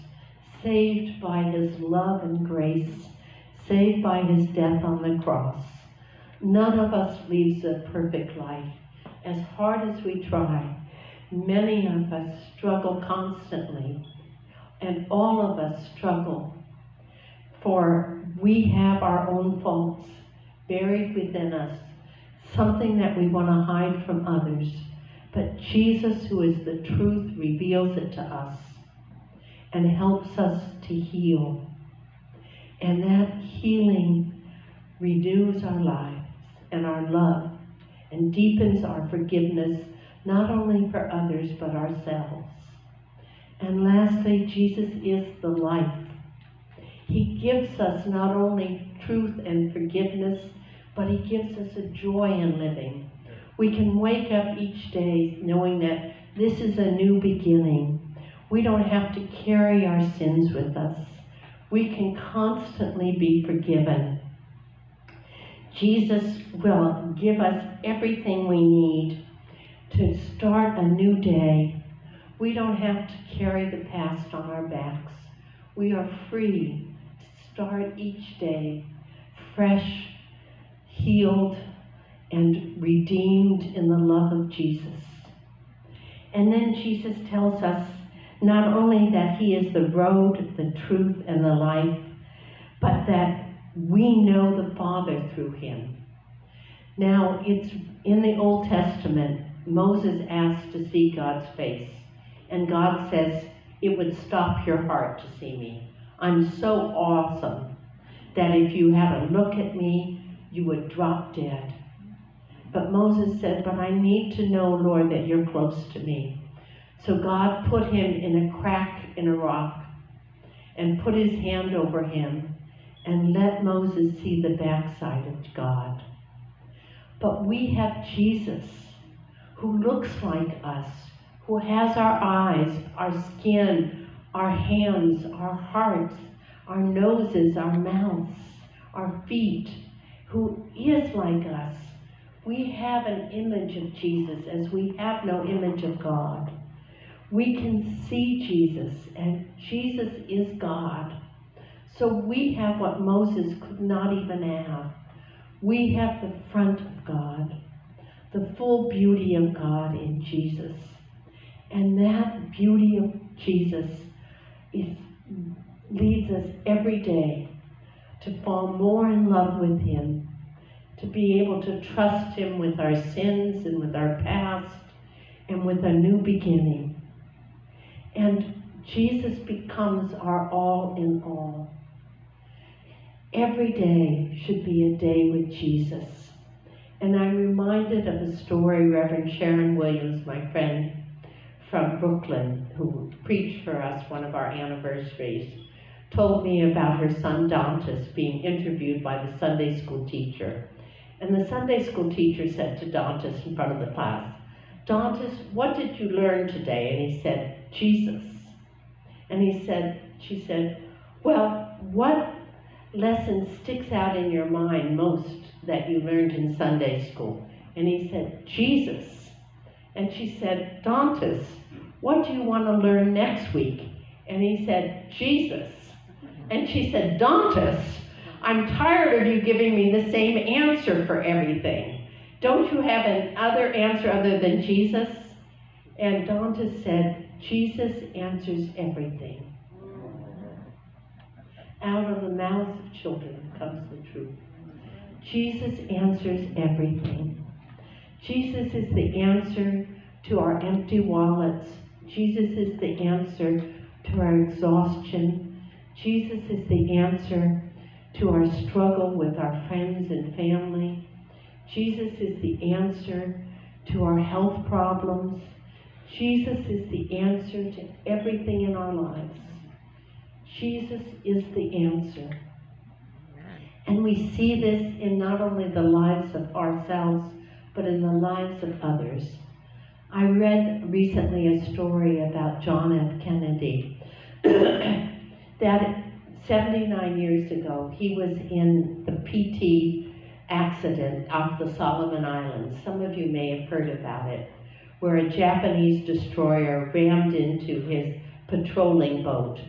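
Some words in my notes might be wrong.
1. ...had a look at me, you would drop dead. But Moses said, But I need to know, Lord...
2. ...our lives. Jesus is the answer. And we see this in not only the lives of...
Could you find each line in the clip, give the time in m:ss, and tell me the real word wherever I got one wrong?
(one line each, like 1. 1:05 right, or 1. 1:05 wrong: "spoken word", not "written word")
1. 1:48 right
2. 4:28 right.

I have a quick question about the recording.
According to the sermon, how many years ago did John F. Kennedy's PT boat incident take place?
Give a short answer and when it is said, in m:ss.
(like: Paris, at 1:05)
79, at 4:46.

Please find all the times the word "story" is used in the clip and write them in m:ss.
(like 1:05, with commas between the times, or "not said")
3:08, 4:41.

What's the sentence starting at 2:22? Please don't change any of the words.
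We have an image of Jesus as we have no image of God.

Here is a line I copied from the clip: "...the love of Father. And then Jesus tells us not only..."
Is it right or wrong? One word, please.
wrong.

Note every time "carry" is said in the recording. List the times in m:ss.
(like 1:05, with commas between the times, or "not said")
0:59, 1:13.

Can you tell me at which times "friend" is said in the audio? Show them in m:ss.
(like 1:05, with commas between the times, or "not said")
3:10, 4:19.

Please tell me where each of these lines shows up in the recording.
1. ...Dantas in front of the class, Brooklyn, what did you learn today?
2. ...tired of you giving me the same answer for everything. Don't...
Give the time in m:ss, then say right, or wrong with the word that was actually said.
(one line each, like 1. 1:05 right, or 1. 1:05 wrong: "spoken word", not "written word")
1. 3:22 wrong: "Dantas", not "Brooklyn"
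2. 3:48 right.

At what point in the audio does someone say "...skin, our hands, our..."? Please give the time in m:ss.
2:13.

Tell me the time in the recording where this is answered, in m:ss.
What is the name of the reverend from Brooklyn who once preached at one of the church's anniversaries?
3:09.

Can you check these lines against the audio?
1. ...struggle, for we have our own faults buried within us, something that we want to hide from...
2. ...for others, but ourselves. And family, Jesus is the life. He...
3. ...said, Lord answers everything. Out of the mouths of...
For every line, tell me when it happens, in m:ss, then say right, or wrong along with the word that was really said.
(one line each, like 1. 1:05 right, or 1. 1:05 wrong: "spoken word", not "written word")
1. 0:15 right
2. 0:40 wrong: "lastly", not "family"
3. 3:56 wrong: "Jesus", not "Lord".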